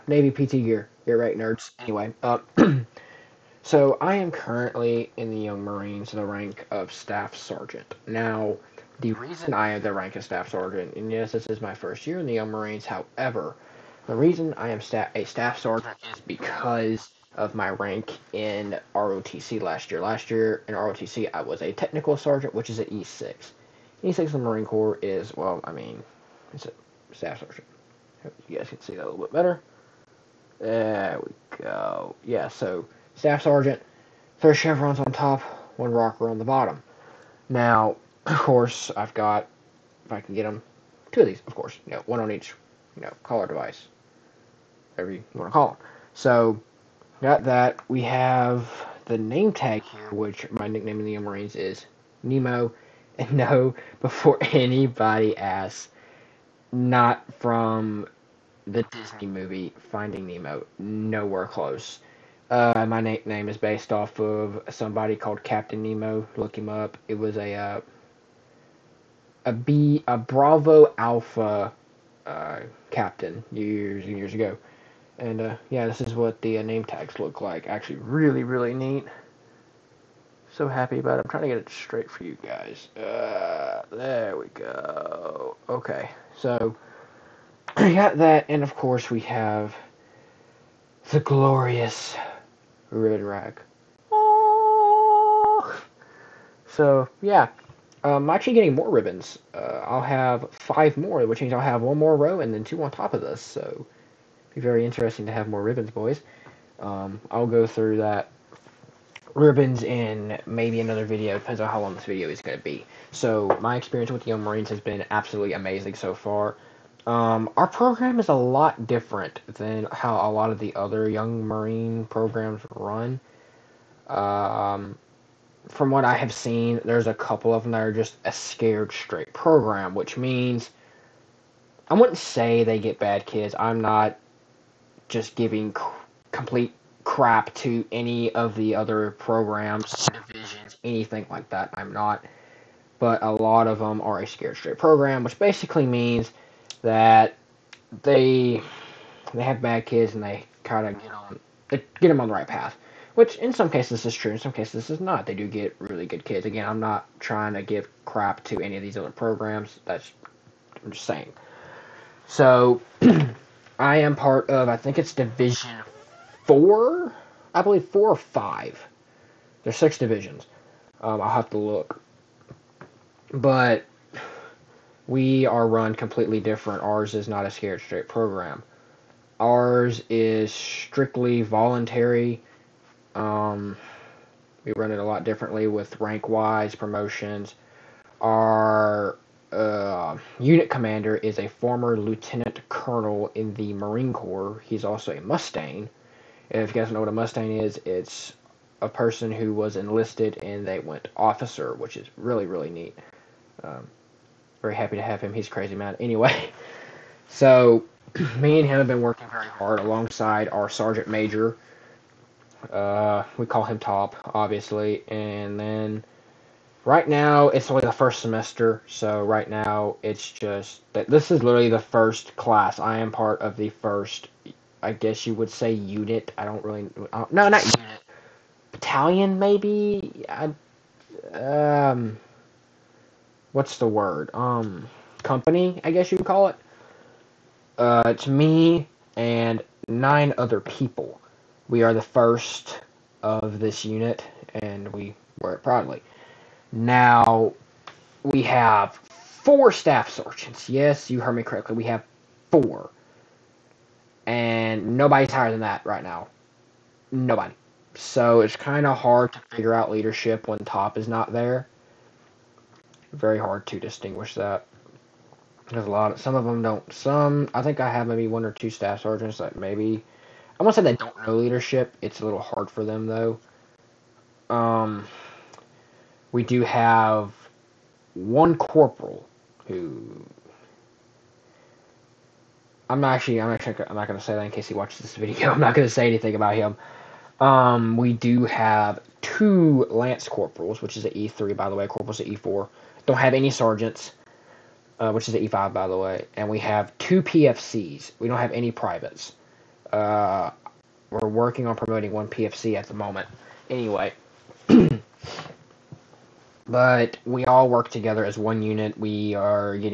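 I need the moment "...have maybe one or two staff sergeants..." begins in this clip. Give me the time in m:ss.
4:27.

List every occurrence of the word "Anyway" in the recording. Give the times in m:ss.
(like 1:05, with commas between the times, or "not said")
0:01, 3:25, 5:03.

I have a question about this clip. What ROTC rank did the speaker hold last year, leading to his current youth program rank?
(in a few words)
Technical Sergeant.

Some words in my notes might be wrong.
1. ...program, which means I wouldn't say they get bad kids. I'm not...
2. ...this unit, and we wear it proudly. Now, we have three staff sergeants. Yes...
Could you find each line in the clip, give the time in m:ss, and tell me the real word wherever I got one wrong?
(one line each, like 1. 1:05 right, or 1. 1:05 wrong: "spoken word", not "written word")
1. 2:09 right
2. 4:03 wrong: "four", not "three".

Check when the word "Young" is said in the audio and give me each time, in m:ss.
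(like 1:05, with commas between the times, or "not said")
0:05, 0:12, 1:54, 2:01.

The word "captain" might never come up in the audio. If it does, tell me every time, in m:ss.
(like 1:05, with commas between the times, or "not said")
1:05, 1:12.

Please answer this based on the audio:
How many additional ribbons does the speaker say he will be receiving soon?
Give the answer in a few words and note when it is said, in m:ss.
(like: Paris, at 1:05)
5, at 1:40.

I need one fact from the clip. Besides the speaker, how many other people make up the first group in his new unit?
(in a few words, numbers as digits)
9.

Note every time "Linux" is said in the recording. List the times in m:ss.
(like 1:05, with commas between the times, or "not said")
not said.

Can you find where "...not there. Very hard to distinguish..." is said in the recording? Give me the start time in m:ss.
4:21.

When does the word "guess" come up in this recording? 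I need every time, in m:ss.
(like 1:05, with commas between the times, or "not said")
3:44, 3:55.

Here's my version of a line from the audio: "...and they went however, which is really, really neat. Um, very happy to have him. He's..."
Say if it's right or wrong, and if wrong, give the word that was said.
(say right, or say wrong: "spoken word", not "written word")
wrong: "officer", not "however".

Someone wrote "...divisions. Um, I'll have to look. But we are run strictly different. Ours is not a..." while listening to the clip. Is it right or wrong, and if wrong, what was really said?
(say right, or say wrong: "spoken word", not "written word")
wrong: "completely", not "strictly".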